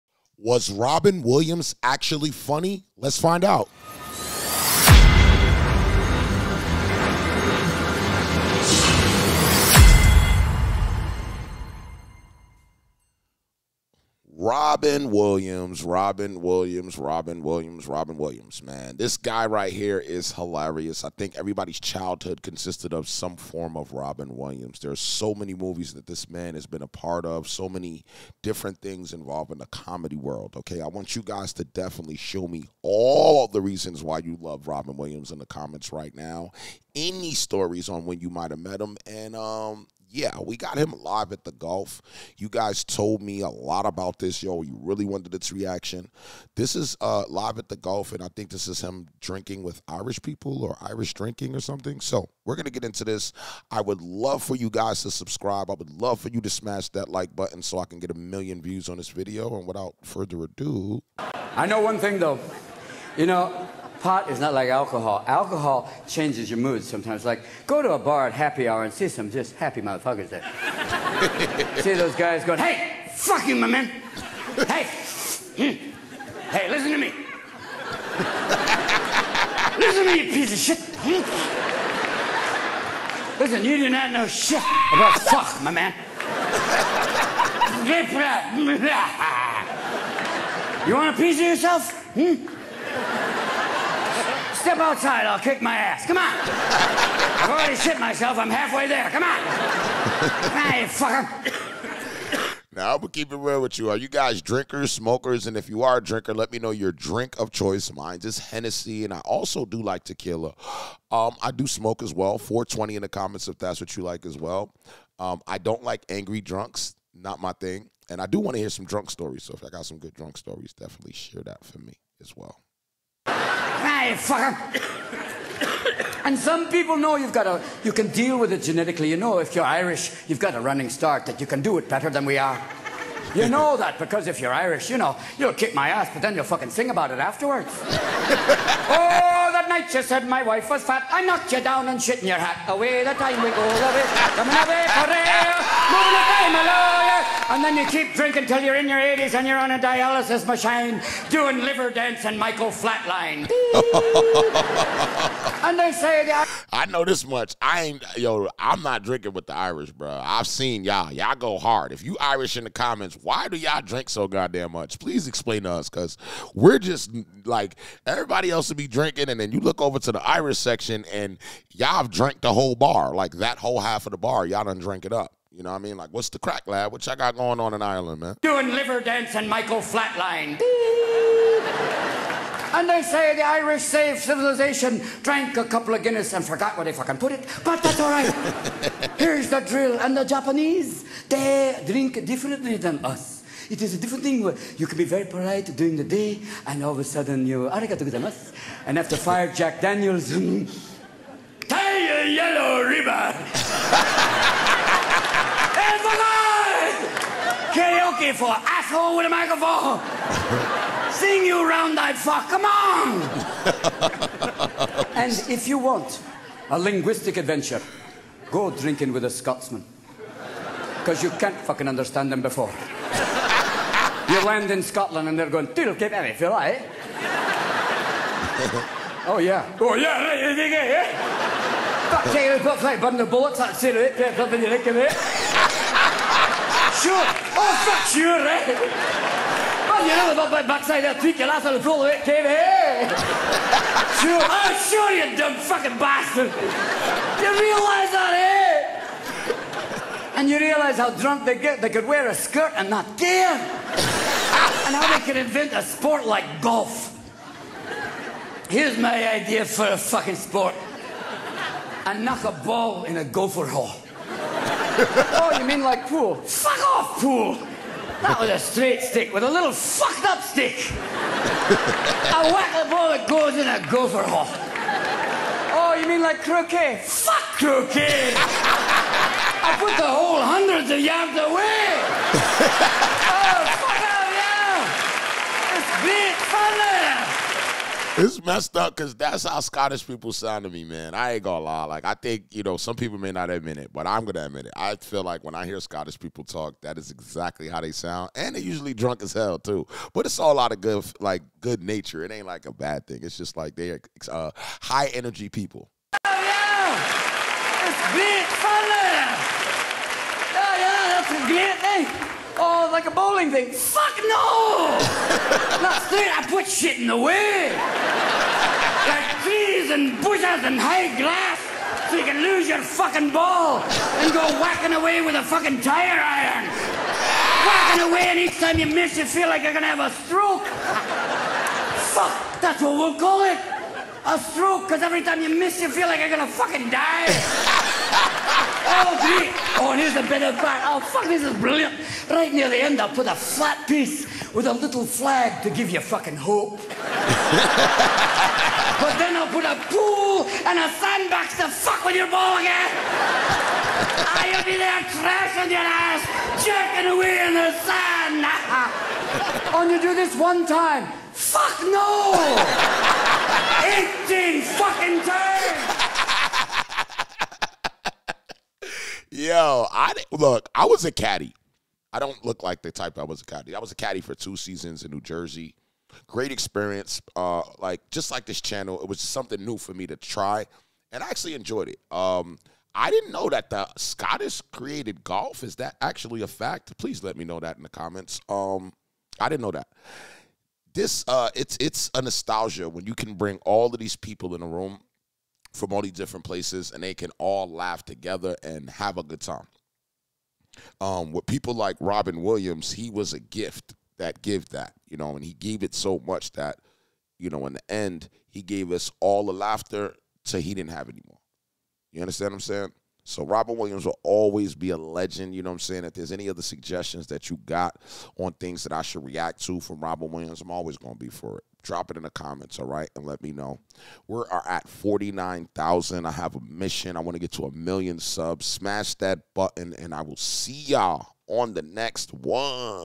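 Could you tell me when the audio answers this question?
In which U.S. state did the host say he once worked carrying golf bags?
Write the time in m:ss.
6:15.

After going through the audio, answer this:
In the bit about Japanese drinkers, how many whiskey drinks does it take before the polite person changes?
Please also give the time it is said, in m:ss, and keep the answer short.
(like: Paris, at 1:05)
5, at 3:19.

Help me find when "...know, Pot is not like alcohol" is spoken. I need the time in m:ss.
1:03.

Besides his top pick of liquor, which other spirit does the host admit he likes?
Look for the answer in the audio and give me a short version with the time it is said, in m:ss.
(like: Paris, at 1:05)
tequila, at 1:50.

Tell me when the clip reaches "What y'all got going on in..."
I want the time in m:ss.
2:56.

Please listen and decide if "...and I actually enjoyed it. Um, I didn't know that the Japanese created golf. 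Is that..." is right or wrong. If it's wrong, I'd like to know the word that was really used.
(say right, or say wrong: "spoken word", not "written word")
wrong: "Scottish", not "Japanese".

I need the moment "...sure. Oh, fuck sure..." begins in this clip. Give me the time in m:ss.
3:57.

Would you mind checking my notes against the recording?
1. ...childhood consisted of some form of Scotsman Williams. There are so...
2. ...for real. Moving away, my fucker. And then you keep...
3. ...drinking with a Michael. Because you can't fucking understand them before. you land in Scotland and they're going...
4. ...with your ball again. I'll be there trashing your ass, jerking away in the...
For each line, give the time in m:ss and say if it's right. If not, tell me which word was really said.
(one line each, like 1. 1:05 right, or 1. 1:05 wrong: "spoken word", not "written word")
1. 0:21 wrong: "Robin", not "Scotsman"
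2. 2:24 wrong: "lawyer", not "fucker"
3. 3:38 wrong: "Scotsman", not "Michael"
4. 5:52 right.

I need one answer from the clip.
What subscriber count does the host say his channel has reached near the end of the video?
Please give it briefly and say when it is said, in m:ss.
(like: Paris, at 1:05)
49,000, at 7:04.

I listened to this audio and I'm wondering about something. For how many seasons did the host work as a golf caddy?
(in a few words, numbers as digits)
2.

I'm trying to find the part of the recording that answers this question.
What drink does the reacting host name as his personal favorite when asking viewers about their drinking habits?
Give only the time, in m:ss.
1:48.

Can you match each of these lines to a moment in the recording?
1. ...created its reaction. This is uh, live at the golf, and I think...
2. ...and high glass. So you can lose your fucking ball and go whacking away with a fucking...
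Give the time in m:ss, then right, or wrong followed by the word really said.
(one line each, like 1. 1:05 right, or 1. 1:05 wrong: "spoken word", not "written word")
1. 0:45 wrong: "wanted", not "created"
2. 5:20 right.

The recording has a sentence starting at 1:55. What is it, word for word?
Um, I don't like angry drunks, not my thing.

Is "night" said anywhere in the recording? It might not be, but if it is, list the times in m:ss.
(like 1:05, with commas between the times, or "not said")
2:19, 5:16.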